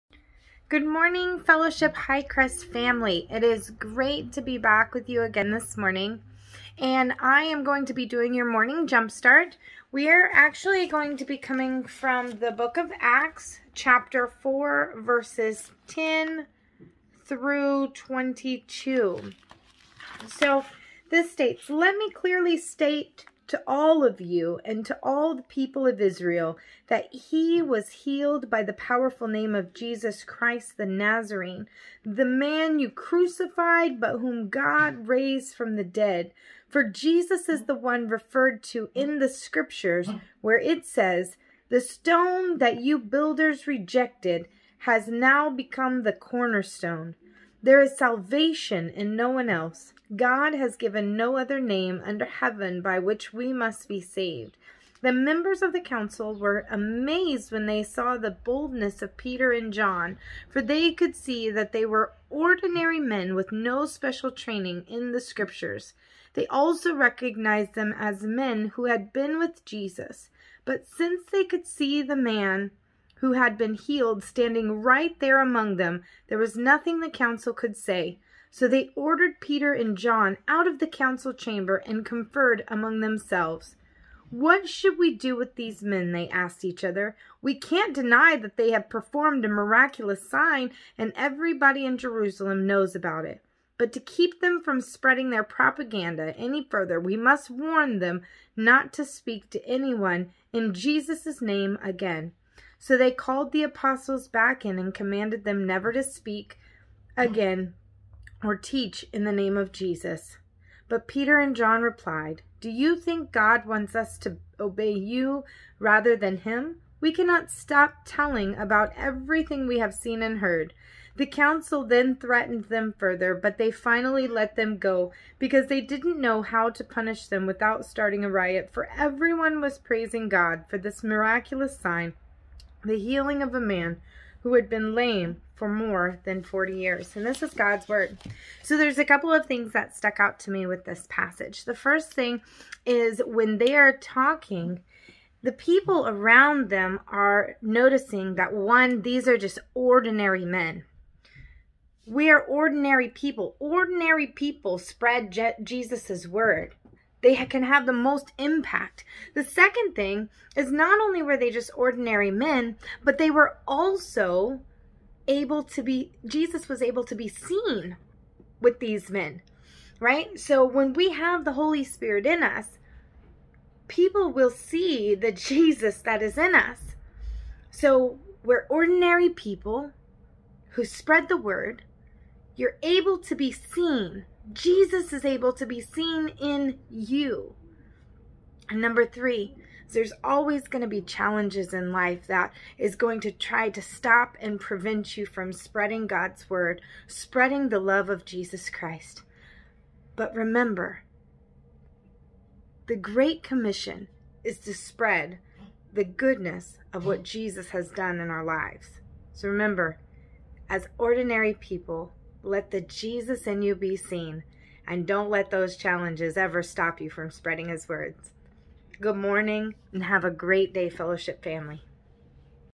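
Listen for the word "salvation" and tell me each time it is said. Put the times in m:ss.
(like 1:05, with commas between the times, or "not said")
0:47.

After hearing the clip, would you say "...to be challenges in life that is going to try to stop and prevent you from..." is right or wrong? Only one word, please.
right.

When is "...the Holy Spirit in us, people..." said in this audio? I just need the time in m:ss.
2:51.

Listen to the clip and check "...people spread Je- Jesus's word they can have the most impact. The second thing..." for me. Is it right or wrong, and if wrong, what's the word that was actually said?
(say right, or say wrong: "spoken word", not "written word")
right.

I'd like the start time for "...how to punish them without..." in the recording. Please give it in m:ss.
2:06.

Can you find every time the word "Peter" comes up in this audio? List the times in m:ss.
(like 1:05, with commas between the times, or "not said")
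0:59, 1:19, 1:51.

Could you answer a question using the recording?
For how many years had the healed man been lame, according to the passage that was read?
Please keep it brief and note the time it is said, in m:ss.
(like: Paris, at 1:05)
More than 40, at 2:15.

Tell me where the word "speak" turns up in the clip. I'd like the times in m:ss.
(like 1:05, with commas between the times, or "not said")
1:39, 1:46.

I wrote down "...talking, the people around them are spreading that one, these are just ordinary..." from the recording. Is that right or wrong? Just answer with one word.
wrong.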